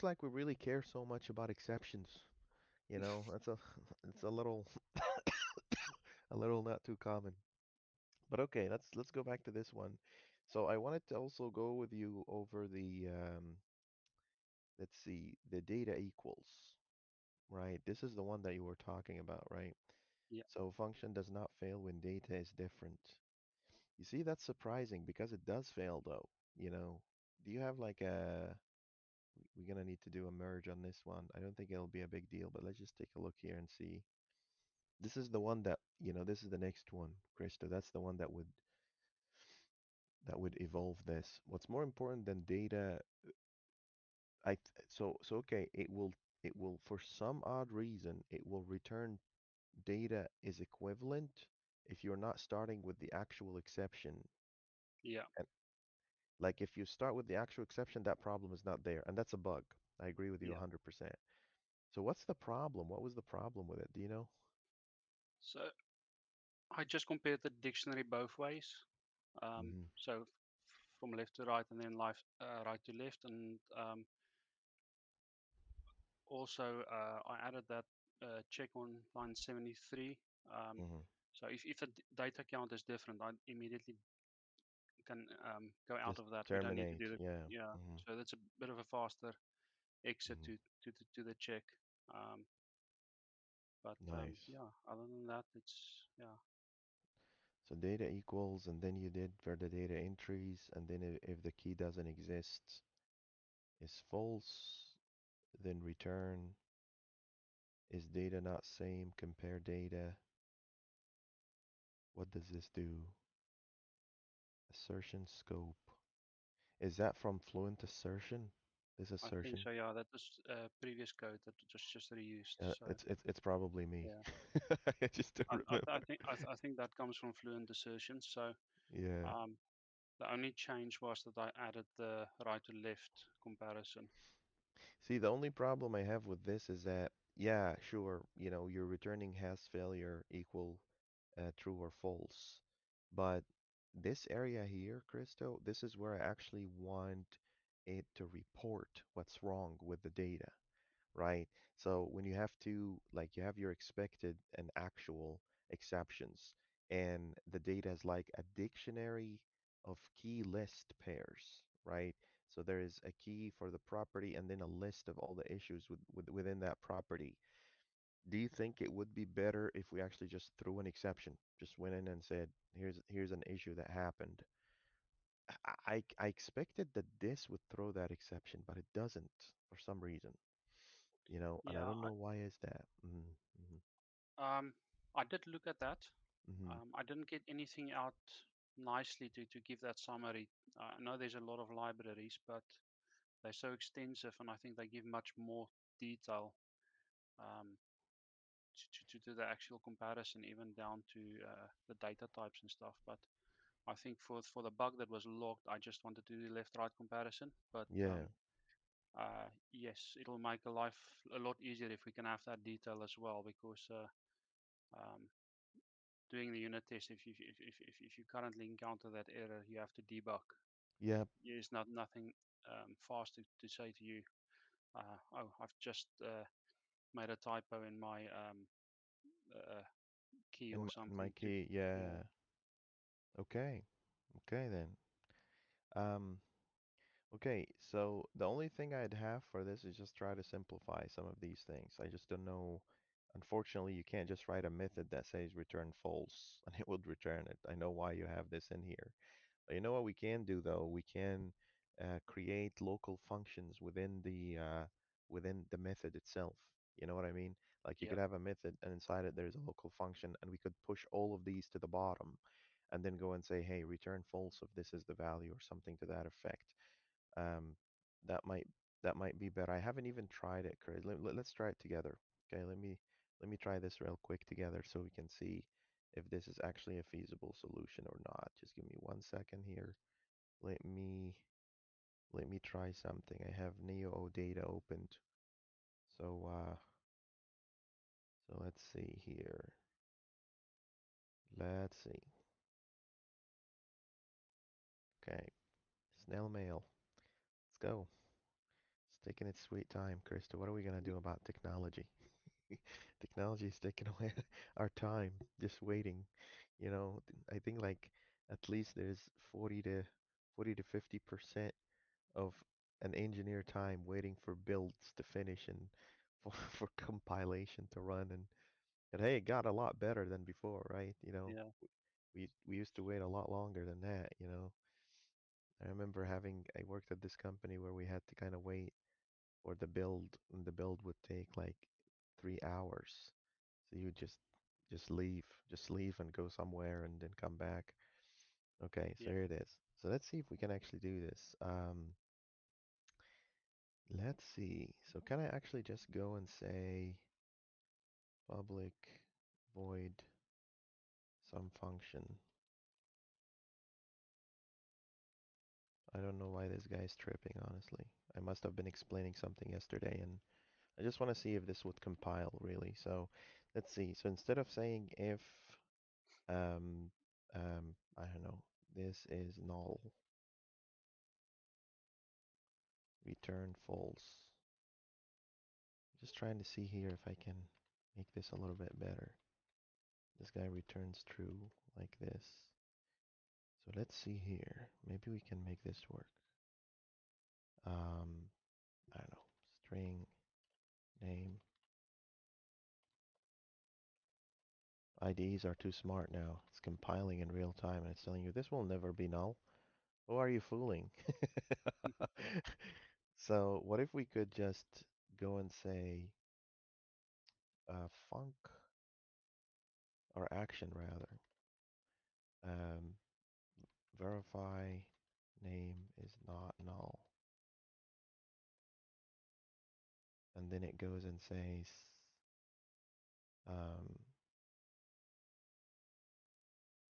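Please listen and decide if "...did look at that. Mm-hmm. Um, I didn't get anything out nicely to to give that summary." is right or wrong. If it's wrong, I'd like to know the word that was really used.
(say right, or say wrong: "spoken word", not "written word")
right.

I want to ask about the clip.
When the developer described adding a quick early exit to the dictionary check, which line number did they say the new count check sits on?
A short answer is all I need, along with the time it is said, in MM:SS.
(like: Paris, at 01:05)
73, at 01:19.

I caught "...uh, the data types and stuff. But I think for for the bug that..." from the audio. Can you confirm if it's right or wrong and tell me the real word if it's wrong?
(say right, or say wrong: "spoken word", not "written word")
right.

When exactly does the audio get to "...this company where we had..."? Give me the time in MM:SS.
05:27.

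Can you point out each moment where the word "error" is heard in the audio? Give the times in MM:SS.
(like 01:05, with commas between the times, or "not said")
03:39.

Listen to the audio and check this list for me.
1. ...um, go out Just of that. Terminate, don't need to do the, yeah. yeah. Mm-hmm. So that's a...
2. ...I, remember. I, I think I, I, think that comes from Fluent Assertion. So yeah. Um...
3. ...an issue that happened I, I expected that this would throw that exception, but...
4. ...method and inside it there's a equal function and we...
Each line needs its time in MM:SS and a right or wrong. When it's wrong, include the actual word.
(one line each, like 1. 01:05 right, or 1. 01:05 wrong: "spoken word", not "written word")
1. 01:25 right
2. 02:05 right
3. 02:53 right
4. 04:18 wrong: "local", not "equal".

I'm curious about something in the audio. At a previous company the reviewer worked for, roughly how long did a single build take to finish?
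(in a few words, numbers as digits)
three hours.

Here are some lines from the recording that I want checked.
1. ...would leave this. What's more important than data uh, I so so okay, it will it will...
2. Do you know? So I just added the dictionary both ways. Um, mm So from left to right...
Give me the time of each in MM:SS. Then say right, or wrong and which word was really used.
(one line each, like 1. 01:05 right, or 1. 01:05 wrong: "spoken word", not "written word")
1. 00:40 wrong: "evolve", not "leave"
2. 01:03 wrong: "compared", not "added".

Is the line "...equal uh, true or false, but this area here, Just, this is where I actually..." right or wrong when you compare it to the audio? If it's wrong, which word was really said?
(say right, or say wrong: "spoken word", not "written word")
wrong: "Christo", not "Just".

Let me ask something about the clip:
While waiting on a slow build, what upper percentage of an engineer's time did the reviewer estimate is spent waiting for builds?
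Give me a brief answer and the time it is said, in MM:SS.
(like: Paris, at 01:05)
50 percent, at 05:10.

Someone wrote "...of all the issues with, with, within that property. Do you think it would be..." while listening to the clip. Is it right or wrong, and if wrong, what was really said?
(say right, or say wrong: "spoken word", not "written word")
right.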